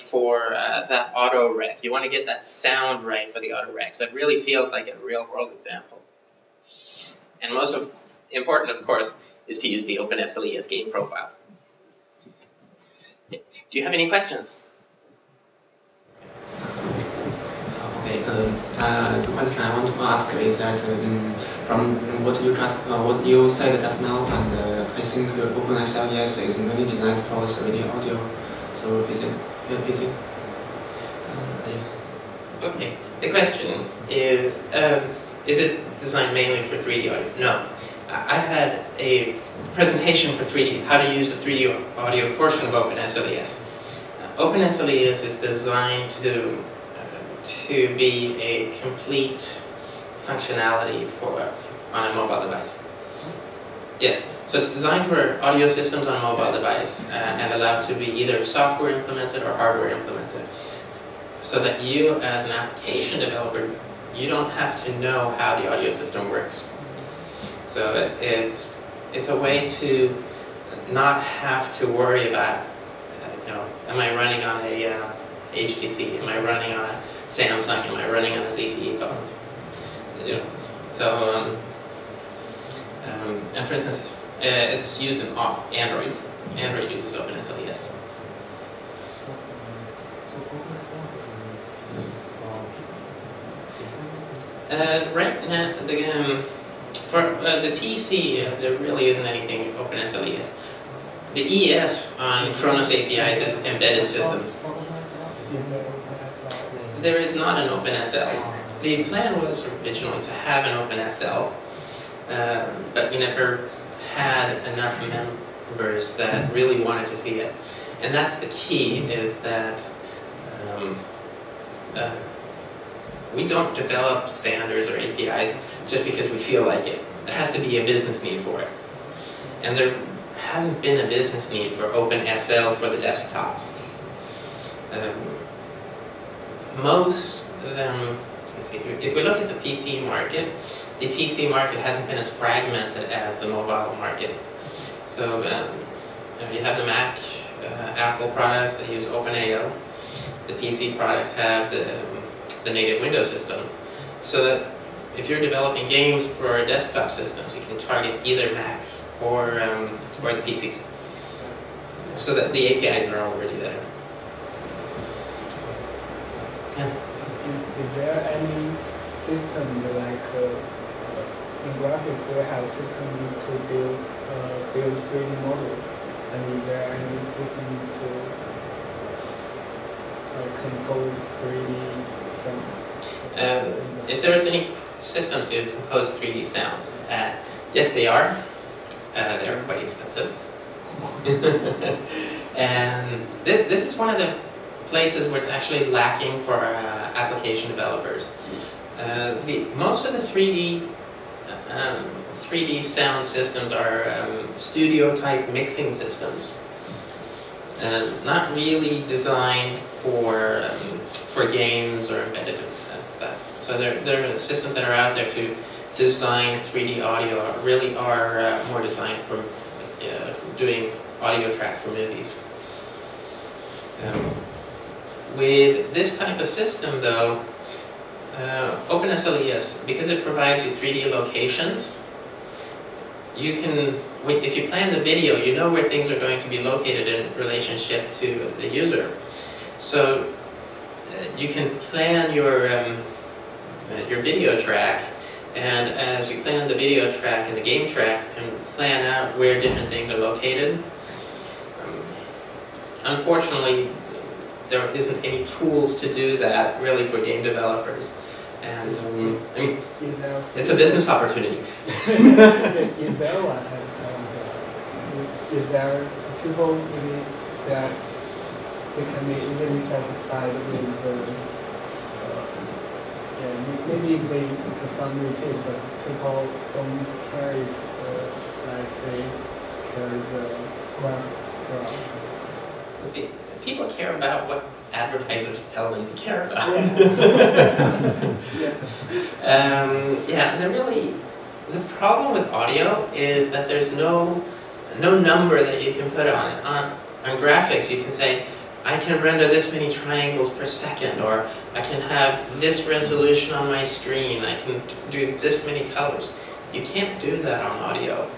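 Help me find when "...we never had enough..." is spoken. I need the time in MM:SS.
01:53.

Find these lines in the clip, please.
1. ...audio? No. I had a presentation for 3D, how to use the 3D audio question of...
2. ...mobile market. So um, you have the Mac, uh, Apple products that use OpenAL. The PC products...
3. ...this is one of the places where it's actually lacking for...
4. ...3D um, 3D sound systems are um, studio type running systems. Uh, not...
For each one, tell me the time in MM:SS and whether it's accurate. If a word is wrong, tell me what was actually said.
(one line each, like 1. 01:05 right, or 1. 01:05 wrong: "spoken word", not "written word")
1. 00:37 wrong: "portion", not "question"
2. 02:23 right
3. 03:13 right
4. 03:20 wrong: "mixing", not "running".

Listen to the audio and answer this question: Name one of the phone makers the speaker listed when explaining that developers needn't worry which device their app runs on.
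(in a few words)
ZTE.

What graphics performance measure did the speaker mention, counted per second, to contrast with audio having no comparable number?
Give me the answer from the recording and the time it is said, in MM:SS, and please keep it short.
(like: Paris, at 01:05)
Triangles, at 04:59.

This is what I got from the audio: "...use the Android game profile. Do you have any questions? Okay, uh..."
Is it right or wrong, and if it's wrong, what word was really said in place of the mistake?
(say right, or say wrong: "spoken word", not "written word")
wrong: "OpenSLES", not "Android".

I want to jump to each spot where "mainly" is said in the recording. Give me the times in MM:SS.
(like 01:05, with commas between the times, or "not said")
00:26, 00:36.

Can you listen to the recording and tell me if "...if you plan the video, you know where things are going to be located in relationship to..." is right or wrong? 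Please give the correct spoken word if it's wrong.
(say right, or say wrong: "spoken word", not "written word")
right.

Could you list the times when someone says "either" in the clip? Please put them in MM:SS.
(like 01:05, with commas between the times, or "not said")
00:58, 02:38.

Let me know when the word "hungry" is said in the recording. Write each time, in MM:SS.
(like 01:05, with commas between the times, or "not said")
not said.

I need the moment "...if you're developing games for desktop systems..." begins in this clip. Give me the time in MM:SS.
02:35.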